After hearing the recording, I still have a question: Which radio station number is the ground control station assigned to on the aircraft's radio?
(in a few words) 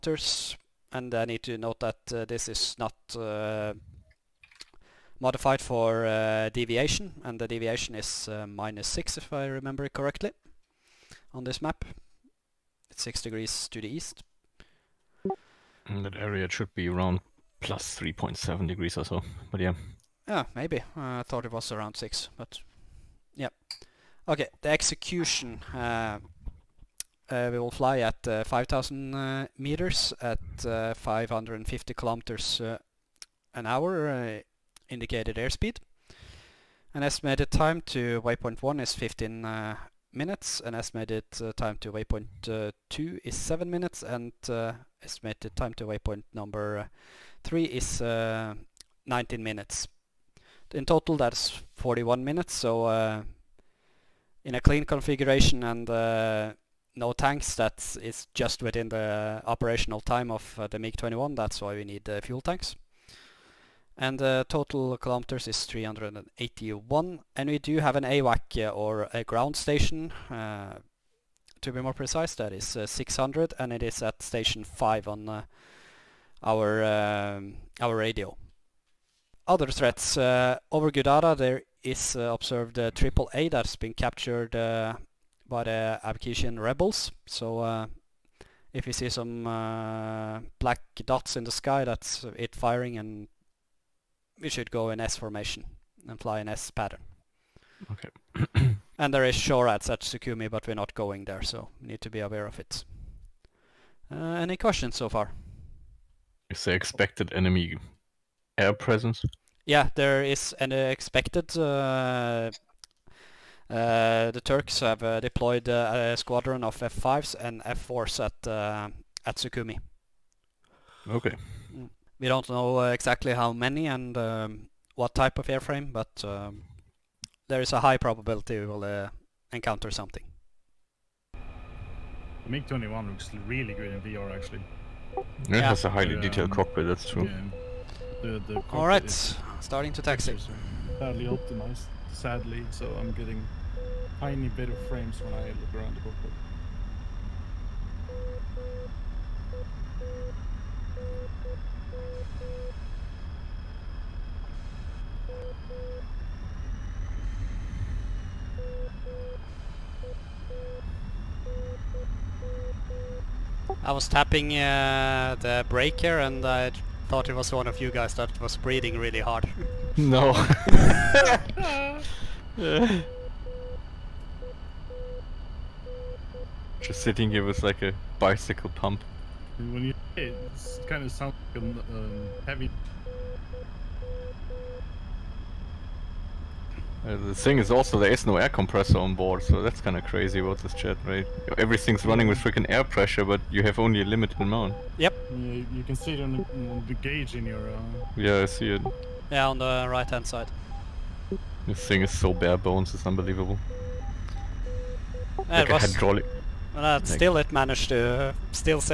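5.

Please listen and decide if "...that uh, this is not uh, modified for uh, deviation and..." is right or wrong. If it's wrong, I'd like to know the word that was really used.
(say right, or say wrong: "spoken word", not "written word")
right.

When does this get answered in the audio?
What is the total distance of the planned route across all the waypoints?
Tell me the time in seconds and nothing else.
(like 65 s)
65 s.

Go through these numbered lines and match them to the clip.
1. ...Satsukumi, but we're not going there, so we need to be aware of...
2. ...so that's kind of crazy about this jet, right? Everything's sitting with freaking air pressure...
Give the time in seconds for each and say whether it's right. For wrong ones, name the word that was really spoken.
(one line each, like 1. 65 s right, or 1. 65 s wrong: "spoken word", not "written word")
1. 99 s right
2. 189 s wrong: "running", not "sitting".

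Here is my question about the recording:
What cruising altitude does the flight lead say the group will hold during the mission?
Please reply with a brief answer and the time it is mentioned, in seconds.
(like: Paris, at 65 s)
5,000 meters, at 28 s.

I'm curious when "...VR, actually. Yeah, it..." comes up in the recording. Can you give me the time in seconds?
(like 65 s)
133 s.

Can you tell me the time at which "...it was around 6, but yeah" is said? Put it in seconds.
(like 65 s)
21 s.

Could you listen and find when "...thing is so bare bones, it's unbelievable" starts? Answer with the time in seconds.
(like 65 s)
201 s.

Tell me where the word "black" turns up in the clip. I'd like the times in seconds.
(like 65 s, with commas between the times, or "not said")
90 s.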